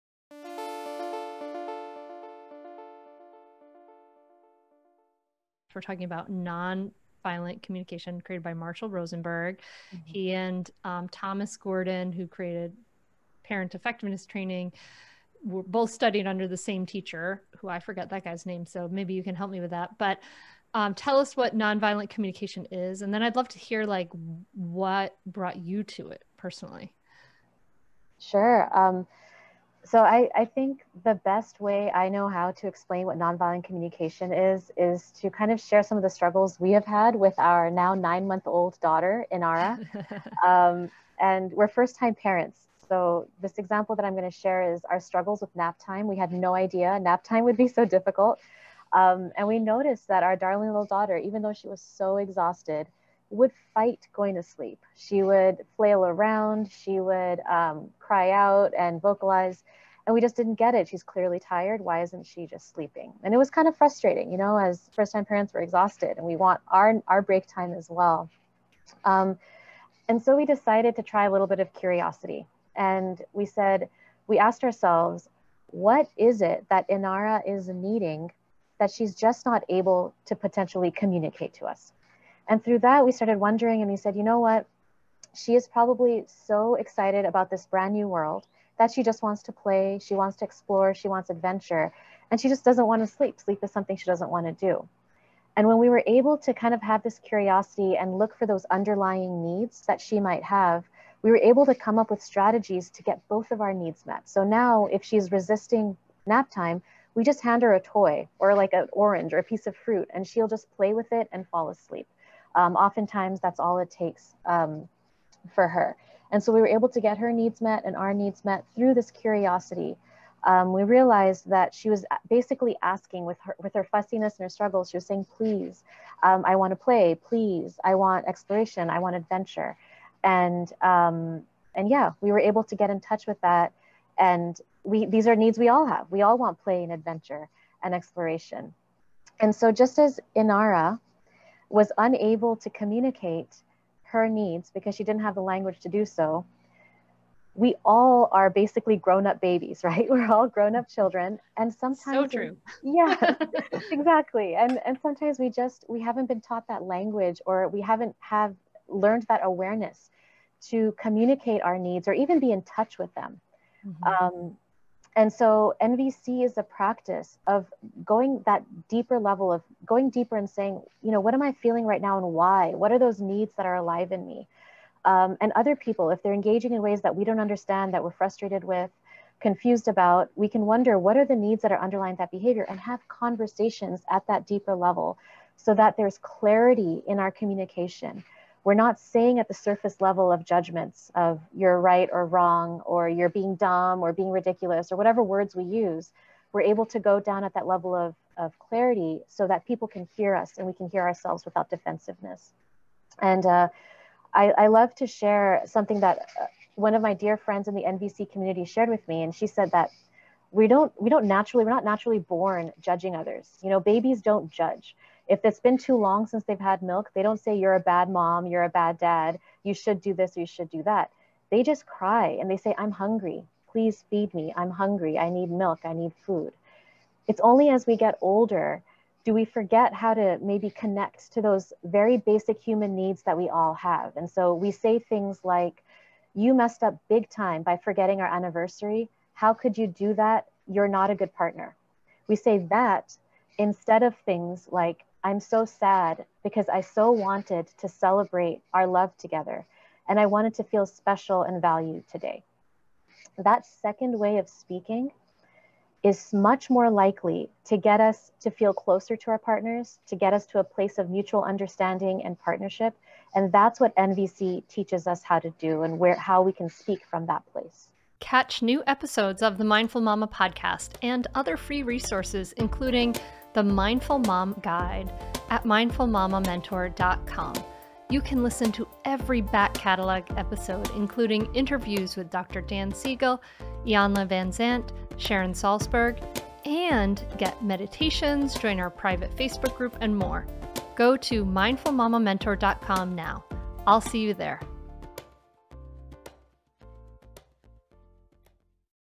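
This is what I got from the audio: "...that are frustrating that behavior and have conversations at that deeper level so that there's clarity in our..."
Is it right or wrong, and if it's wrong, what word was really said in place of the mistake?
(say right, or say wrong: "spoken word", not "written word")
wrong: "underlying", not "frustrating".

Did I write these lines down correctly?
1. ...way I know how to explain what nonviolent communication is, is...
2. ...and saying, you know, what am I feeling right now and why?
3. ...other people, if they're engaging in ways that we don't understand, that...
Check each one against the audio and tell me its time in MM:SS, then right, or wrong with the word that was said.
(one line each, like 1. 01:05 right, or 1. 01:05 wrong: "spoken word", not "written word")
1. 00:31 right
2. 02:50 right
3. 02:55 right.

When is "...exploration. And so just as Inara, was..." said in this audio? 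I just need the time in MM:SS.
02:17.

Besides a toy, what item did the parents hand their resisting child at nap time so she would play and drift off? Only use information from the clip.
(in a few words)
An orange.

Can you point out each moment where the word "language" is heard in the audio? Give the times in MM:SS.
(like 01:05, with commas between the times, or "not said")
02:25, 02:36.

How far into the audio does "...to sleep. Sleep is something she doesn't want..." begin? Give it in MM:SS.
01:33.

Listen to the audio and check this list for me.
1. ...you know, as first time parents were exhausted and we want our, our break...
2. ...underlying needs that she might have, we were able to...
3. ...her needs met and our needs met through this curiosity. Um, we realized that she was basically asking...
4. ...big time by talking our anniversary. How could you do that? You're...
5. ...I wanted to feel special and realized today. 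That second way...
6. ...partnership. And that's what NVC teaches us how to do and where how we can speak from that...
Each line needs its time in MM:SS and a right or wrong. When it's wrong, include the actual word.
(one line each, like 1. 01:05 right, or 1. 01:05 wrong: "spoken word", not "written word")
1. 01:04 right
2. 01:38 right
3. 01:57 right
4. 03:57 wrong: "forgetting", not "talking"
5. 04:10 wrong: "valued", not "realized"
6. 04:22 right.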